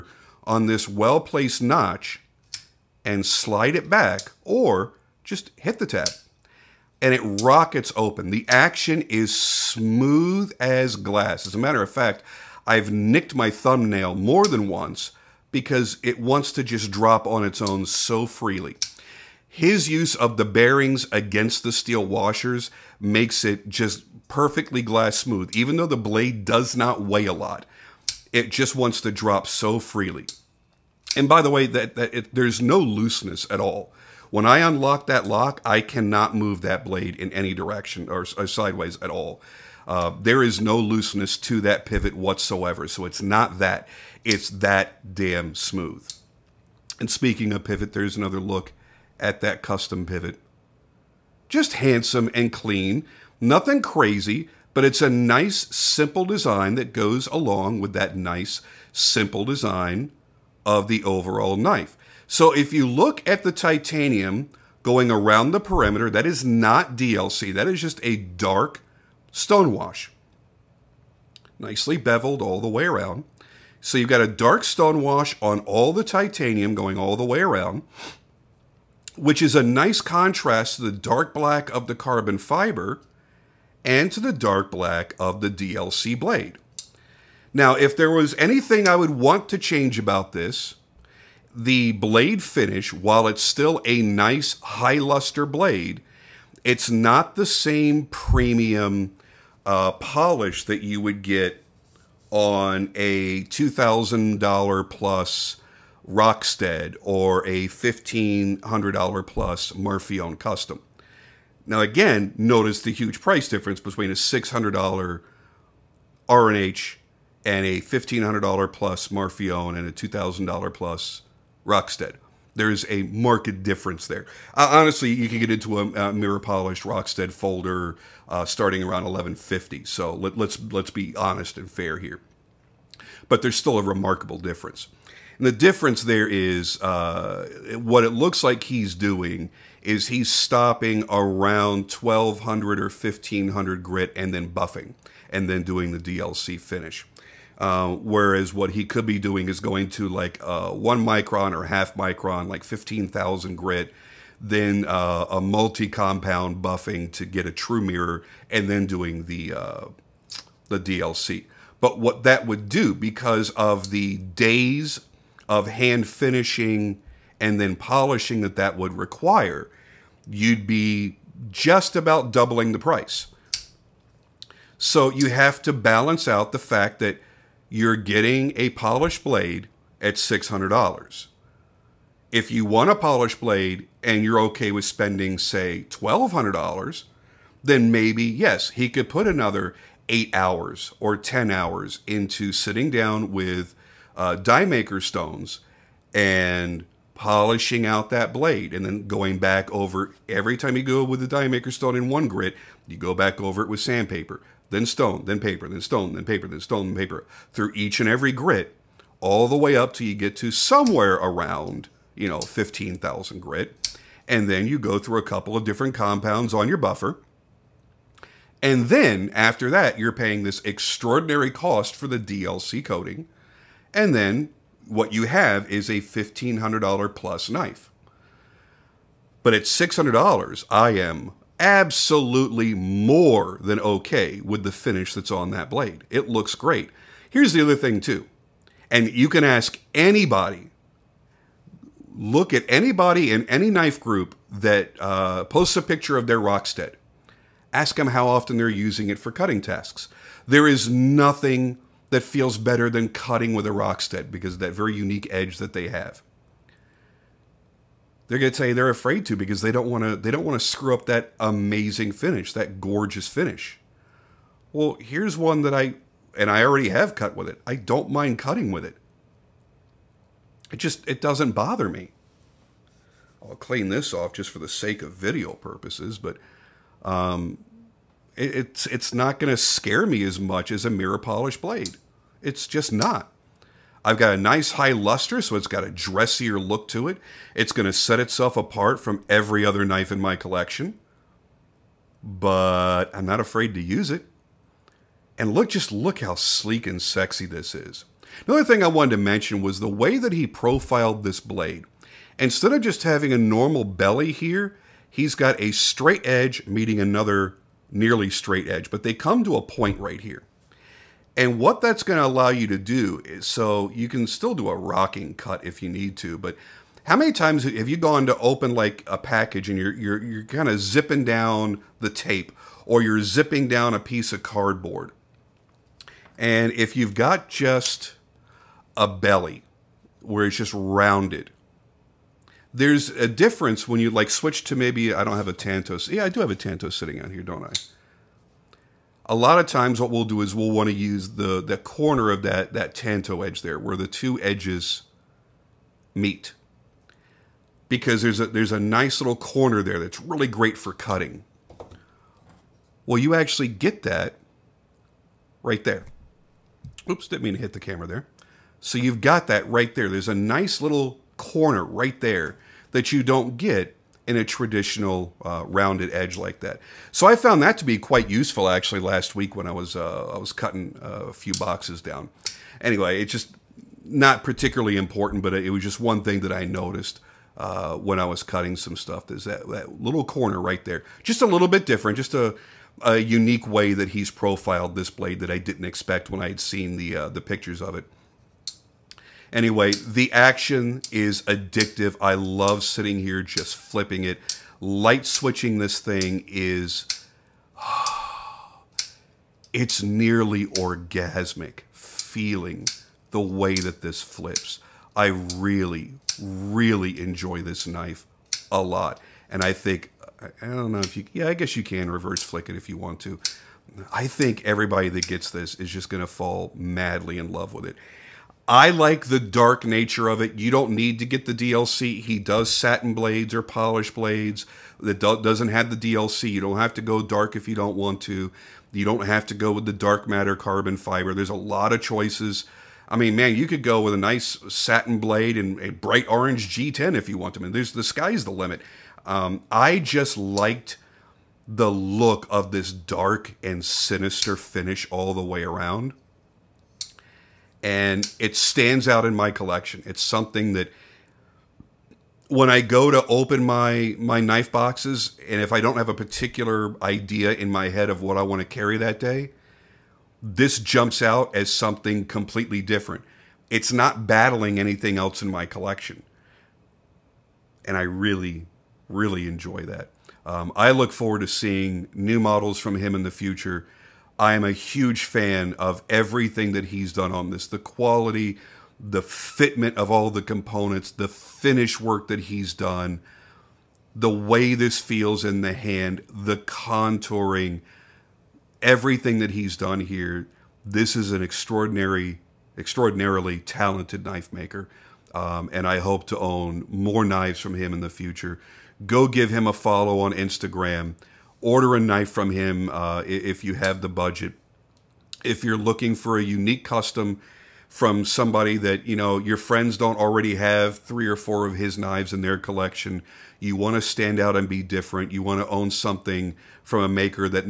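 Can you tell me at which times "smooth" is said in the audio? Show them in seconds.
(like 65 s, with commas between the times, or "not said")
9 s, 25 s, 45 s.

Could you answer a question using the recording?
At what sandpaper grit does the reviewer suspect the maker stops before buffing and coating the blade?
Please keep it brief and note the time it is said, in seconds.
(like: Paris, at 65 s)
1200 or 1500, at 141 s.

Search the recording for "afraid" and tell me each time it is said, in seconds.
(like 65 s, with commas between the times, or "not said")
258 s, 293 s.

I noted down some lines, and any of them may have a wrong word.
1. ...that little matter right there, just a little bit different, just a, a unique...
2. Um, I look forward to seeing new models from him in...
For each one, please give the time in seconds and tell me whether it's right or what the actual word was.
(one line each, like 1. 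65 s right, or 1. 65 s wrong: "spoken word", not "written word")
1. 379 s wrong: "corner", not "matter"
2. 470 s right.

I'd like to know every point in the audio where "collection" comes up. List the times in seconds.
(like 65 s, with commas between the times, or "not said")
290 s, 449 s, 465 s, 512 s.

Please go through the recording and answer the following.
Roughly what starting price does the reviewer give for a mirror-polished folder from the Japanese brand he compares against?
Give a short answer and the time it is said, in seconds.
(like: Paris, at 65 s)
1150, at 129 s.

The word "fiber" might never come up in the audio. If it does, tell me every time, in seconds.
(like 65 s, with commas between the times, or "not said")
82 s, 430 s.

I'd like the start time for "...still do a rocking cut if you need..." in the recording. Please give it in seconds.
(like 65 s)
314 s.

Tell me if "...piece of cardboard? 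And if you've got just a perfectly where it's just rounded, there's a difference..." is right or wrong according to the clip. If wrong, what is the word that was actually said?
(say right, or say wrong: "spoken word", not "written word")
wrong: "belly", not "perfectly".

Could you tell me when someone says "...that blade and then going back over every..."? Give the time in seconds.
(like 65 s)
198 s.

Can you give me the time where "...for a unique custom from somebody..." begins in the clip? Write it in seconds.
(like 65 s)
506 s.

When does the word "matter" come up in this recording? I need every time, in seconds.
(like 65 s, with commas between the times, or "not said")
11 s, 430 s.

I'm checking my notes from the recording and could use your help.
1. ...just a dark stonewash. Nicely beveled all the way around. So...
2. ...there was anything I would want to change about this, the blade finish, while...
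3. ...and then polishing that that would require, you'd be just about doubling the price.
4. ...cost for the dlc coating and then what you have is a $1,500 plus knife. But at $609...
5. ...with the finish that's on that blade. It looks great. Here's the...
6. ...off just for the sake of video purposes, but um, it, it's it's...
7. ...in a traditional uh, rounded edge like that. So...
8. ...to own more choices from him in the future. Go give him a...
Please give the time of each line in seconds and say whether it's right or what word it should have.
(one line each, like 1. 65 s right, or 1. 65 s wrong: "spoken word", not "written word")
1. 67 s right
2. 87 s right
3. 167 s right
4. 221 s wrong: "600", not "609"
5. 234 s right
6. 274 s right
7. 364 s right
8. 496 s wrong: "knives", not "choices".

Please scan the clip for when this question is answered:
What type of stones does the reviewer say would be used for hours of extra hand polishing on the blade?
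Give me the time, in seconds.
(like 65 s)
194 s.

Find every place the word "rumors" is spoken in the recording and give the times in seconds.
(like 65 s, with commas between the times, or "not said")
not said.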